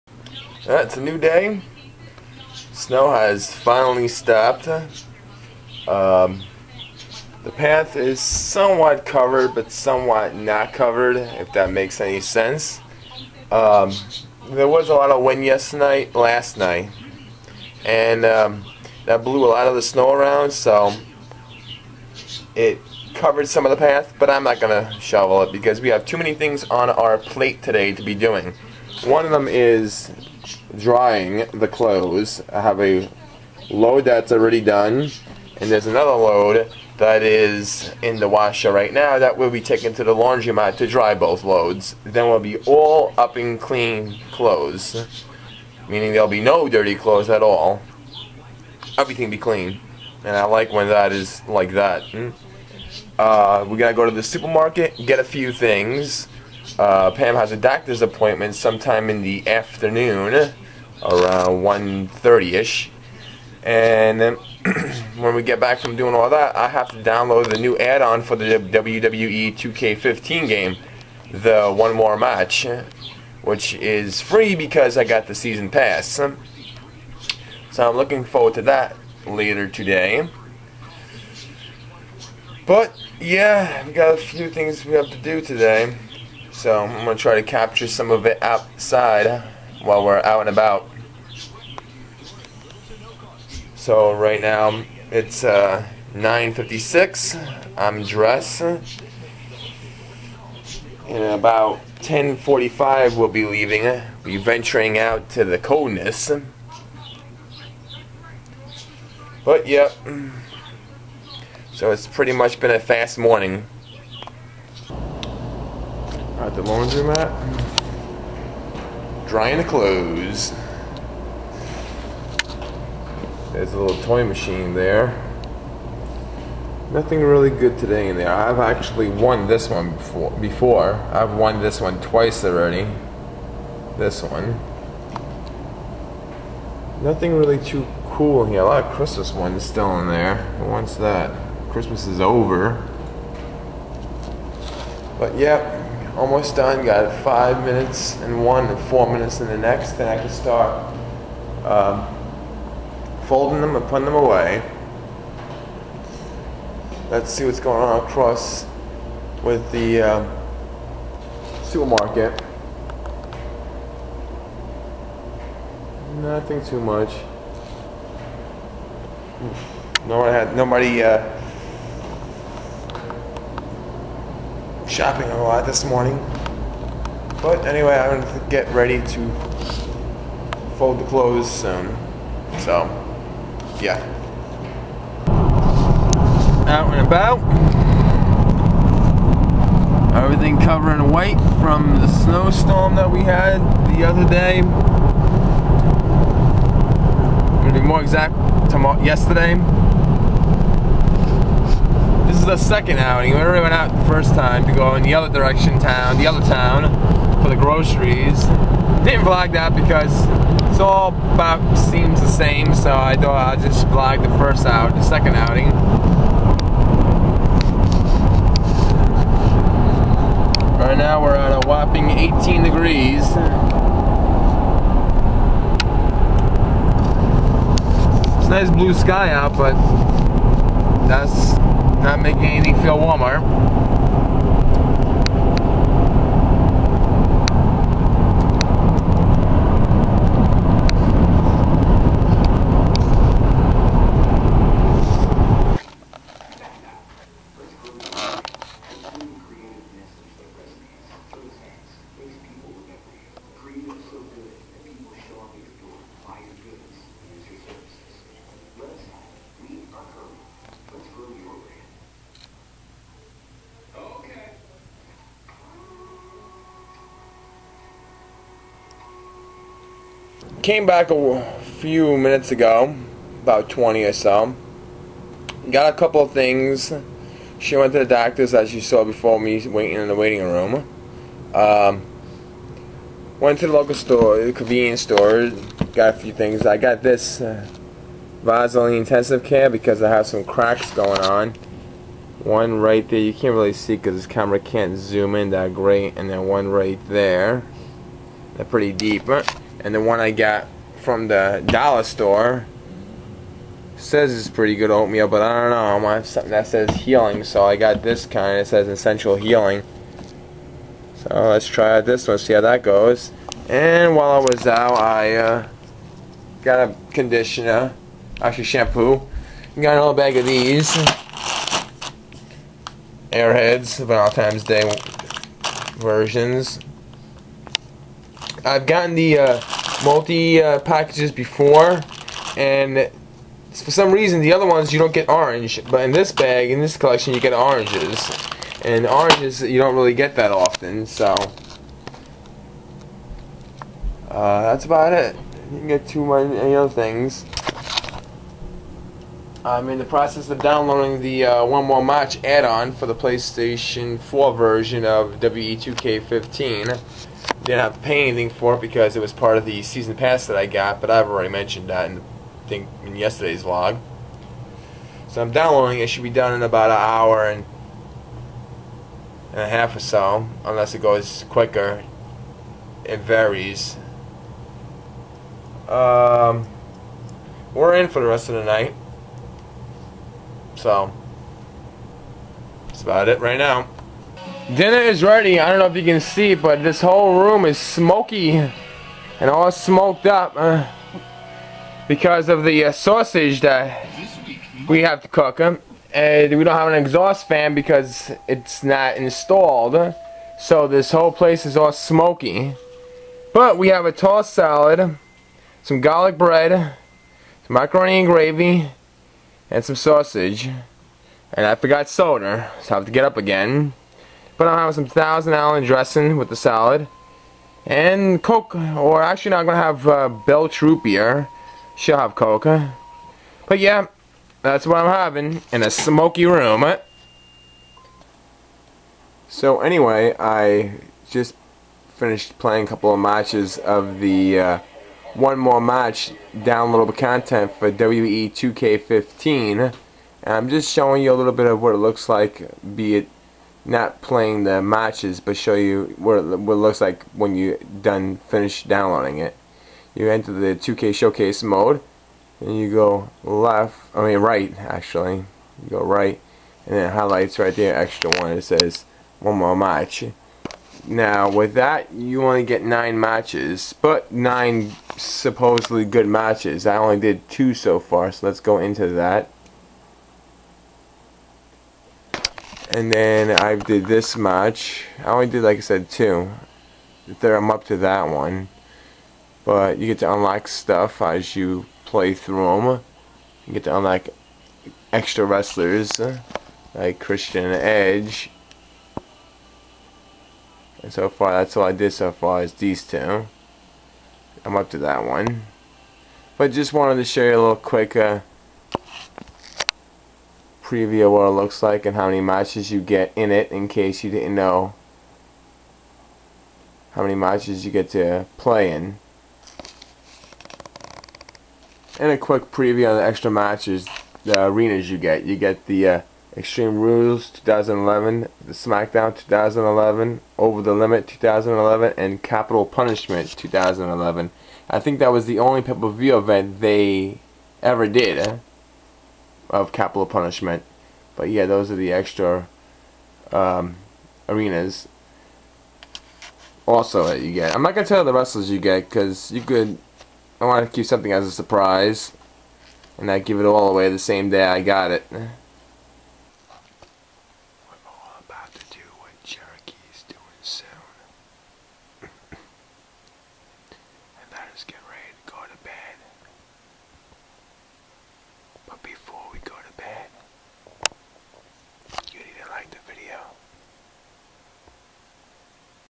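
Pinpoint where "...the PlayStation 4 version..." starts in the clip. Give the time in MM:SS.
05:53.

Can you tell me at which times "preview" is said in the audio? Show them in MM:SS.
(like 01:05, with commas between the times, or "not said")
08:20, 08:32.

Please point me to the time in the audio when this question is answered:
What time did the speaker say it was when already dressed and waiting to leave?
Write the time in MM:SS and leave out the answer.
01:36.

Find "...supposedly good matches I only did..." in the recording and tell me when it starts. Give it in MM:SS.
07:45.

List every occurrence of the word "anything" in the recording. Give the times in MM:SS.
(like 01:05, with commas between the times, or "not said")
03:52, 05:58.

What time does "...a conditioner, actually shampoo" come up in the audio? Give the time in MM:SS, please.
05:16.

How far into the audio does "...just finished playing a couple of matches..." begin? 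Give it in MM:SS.
07:11.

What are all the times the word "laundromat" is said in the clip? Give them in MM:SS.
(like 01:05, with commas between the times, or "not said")
00:40, 01:56.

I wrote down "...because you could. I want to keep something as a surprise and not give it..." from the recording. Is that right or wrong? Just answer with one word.
right.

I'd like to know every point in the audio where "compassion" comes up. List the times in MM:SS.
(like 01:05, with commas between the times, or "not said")
not said.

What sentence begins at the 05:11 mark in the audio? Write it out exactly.
So let's try out this one, see how that goes.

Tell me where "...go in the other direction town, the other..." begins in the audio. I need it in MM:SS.
03:24.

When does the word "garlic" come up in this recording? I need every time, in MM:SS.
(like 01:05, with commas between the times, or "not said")
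06:45.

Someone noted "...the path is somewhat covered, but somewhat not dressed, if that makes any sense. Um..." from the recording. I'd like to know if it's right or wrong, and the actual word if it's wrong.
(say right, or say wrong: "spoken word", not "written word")
wrong: "covered", not "dressed".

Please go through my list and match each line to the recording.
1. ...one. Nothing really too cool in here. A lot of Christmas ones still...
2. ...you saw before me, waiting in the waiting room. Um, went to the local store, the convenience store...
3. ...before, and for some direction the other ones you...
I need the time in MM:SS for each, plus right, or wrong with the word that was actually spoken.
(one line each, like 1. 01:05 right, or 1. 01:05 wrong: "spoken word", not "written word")
1. 02:14 right
2. 04:38 right
3. 05:31 wrong: "reason", not "direction".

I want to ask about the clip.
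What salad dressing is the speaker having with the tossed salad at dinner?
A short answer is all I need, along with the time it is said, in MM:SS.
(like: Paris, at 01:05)
Thousand Island, at 06:55.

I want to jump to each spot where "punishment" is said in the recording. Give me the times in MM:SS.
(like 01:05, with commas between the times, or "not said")
08:42, 08:50.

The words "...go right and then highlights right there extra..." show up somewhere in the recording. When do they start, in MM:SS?
07:35.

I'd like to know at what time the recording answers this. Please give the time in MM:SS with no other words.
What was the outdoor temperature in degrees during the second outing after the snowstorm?
03:42.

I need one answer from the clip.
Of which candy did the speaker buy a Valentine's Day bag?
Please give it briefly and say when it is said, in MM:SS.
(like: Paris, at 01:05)
Airheads, at 05:23.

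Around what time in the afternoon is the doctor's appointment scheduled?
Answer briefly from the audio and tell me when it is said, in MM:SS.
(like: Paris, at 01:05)
1:30, at 01:01.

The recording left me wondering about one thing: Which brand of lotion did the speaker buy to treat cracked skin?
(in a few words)
Vaseline Intensive Care.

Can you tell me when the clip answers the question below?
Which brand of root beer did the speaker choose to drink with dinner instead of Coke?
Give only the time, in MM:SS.
07:00.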